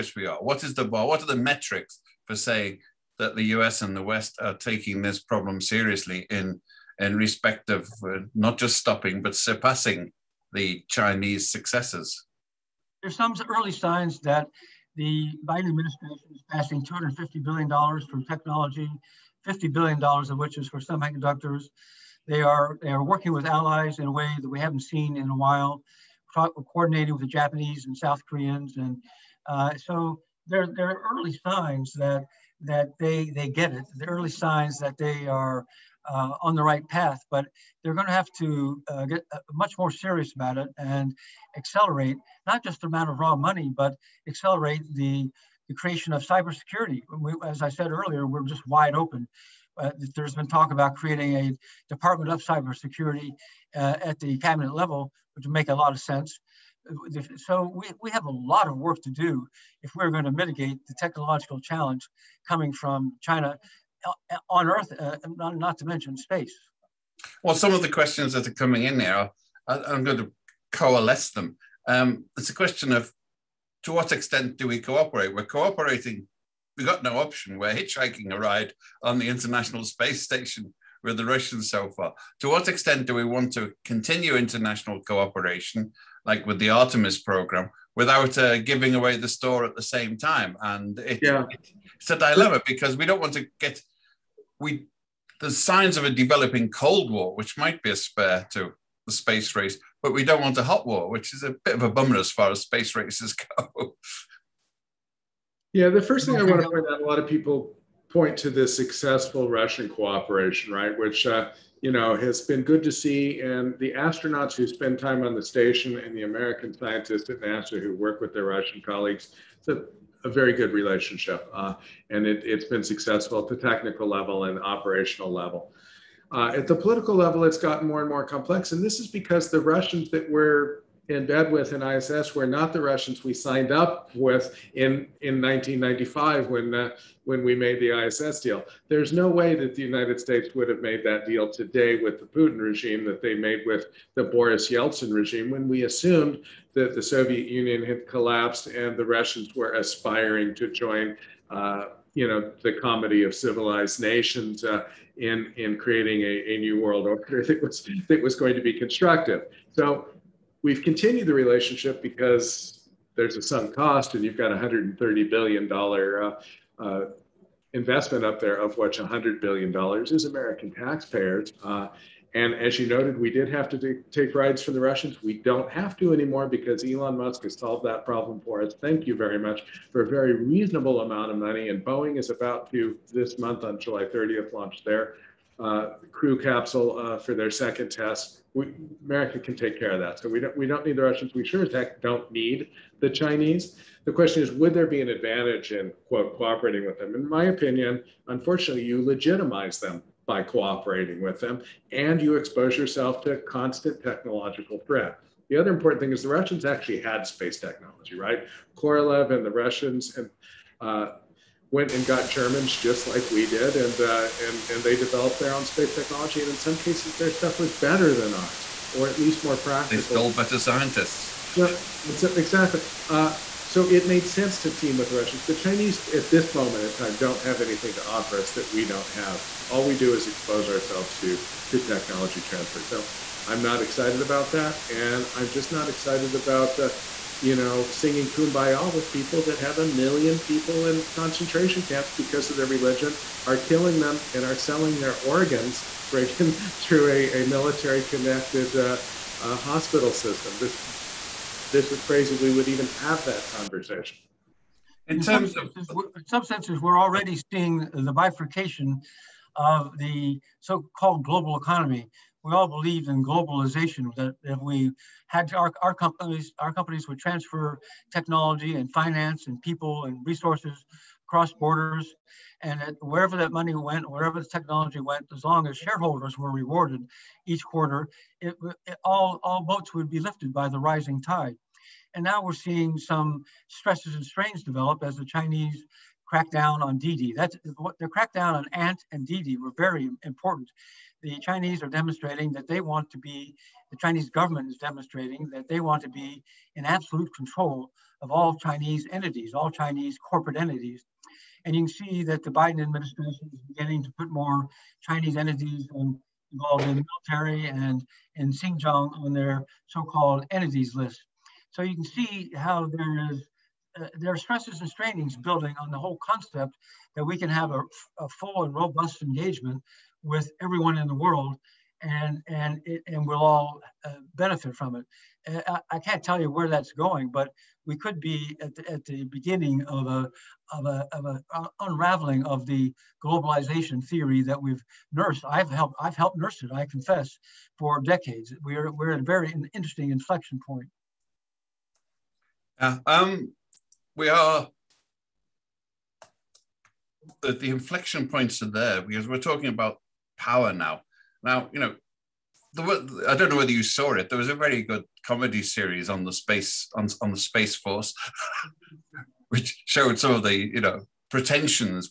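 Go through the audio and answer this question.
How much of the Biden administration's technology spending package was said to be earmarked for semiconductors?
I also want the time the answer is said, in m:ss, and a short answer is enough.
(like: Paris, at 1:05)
$50 billion, at 0:19.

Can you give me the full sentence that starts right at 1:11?
Um, it's a question of to what extent do we cooperate?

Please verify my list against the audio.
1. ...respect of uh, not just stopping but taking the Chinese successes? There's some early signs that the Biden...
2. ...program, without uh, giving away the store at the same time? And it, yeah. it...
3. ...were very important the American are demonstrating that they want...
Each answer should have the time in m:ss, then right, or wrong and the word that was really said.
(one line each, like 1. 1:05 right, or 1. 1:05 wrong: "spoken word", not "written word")
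1. 0:07 wrong: "surpassing", not "taking"
2. 1:27 right
3. 4:49 wrong: "Chinese", not "American".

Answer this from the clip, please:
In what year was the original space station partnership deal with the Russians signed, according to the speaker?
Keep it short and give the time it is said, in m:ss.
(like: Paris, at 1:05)
1995, at 2:15.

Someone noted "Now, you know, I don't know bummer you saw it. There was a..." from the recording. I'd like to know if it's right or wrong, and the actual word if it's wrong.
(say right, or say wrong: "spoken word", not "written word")
wrong: "whether", not "bummer".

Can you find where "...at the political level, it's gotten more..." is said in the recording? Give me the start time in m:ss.
2:06.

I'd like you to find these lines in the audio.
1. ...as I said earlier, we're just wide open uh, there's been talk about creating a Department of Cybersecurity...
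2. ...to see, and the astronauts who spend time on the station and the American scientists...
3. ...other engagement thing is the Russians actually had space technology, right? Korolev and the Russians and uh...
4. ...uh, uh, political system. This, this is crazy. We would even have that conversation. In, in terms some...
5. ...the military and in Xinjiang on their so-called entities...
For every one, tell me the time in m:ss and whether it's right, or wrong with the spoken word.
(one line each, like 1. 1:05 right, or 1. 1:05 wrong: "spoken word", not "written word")
1. 0:47 right
2. 1:52 right
3. 3:25 wrong: "important", not "engagement"
4. 4:08 wrong: "hospital", not "political"
5. 5:06 right.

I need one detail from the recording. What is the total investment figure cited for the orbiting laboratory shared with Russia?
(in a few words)
$130 billion.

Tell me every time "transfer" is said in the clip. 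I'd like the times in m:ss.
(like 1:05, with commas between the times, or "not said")
3:52, 4:27.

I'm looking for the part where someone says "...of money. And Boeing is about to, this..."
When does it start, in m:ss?
3:01.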